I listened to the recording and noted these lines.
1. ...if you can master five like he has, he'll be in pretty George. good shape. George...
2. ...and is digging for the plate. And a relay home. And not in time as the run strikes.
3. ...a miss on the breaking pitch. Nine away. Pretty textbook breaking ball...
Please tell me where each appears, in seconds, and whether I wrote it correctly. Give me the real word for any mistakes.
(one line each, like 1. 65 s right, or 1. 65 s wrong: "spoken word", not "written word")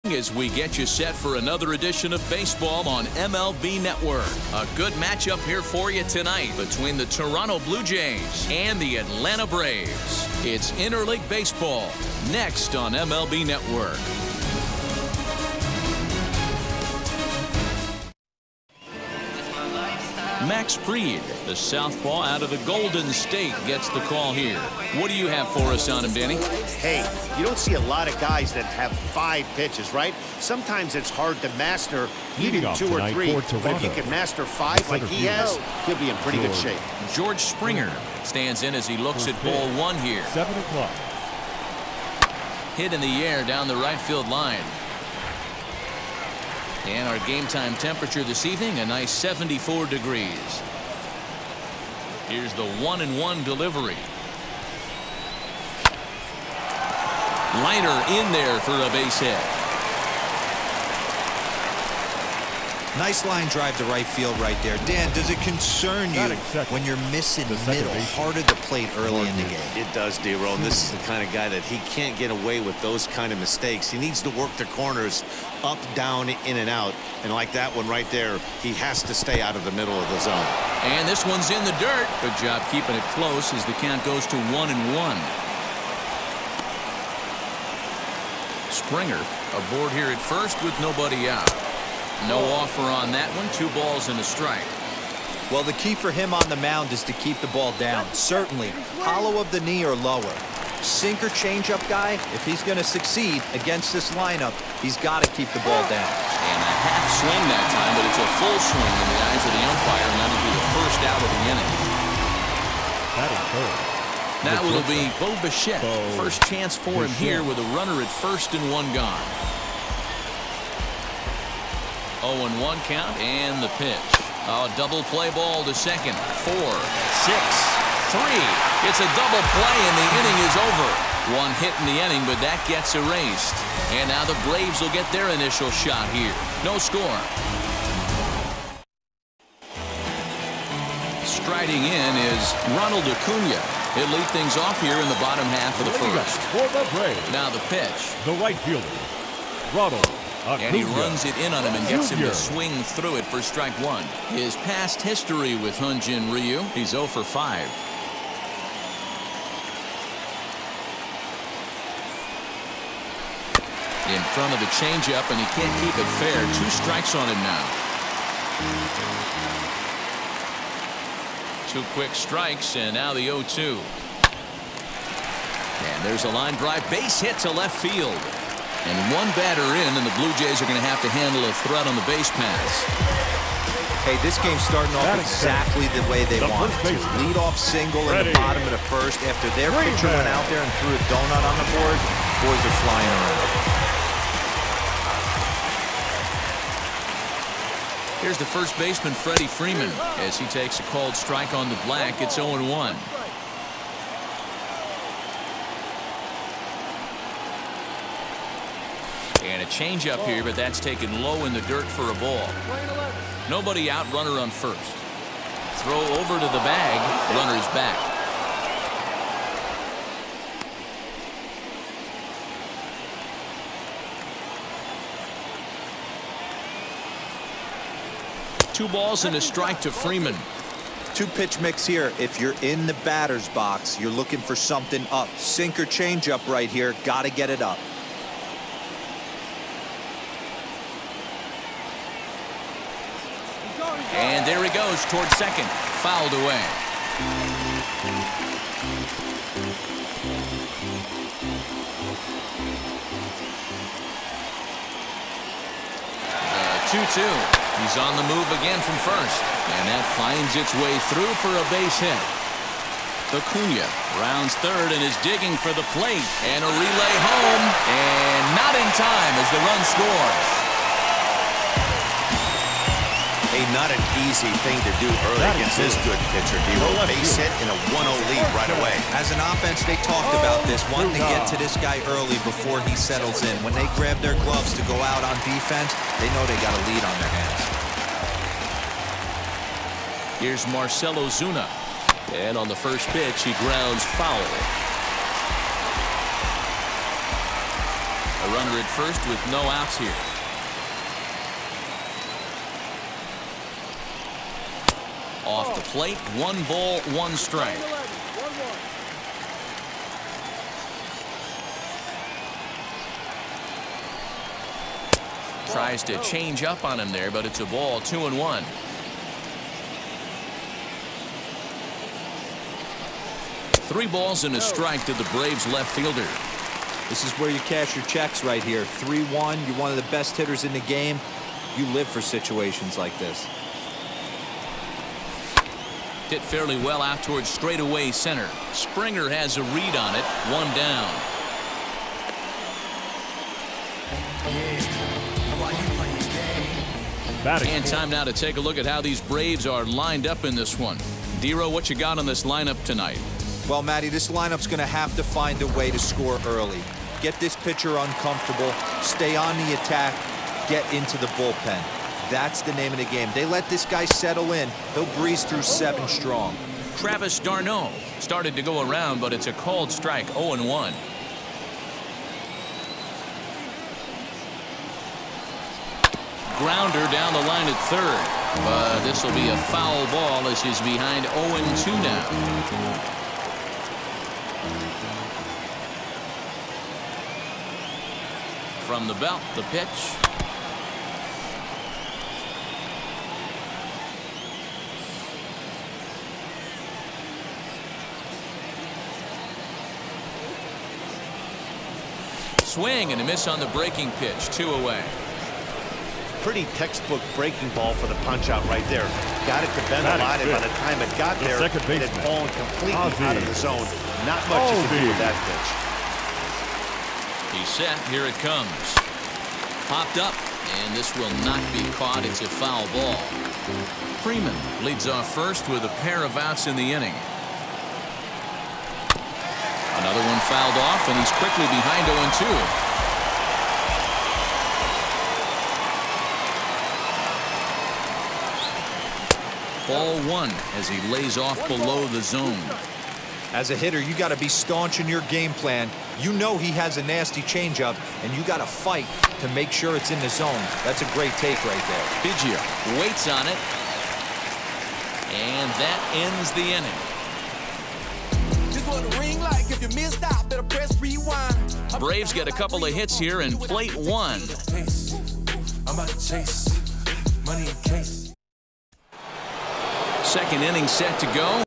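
1. 33 s right
2. 264 s wrong: "scores", not "strikes"
3. 403 s wrong: "Two", not "Nine".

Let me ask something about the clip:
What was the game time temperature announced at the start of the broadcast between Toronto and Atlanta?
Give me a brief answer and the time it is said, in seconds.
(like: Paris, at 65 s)
74 degrees, at 49 s.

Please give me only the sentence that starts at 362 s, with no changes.
That's the name of the game.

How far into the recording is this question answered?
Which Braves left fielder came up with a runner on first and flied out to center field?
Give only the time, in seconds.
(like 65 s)
290 s.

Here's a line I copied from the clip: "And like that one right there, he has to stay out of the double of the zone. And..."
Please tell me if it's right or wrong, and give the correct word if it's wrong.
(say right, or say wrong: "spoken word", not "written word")
wrong: "middle", not "double".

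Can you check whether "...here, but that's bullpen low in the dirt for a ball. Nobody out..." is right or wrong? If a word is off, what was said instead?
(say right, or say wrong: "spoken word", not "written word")
wrong: "taken", not "bullpen".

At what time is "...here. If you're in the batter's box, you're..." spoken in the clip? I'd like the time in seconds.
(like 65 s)
231 s.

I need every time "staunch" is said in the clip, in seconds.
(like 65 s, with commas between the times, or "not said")
444 s.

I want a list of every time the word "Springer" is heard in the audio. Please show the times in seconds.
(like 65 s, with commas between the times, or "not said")
37 s, 88 s, 338 s.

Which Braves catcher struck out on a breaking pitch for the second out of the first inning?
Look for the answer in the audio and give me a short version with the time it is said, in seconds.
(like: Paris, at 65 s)
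Travis d'Arnaud, at 366 s.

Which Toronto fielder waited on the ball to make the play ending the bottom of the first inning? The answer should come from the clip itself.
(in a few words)
Biggio.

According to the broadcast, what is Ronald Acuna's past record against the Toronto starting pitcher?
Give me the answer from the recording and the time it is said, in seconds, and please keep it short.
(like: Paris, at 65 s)
0 for 5, at 156 s.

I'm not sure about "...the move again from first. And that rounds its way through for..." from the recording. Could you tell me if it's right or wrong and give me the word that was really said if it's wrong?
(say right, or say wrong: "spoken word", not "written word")
wrong: "finds", not "rounds".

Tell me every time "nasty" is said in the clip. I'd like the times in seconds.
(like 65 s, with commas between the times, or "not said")
447 s.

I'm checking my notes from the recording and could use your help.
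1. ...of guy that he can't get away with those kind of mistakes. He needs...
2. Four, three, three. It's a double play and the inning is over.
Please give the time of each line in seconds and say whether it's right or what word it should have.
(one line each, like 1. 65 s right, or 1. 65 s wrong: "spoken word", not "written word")
1. 71 s right
2. 126 s wrong: "six", not "three".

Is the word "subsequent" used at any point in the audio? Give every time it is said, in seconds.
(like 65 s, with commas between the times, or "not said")
not said.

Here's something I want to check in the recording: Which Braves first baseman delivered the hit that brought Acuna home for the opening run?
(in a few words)
Freddie Freeman.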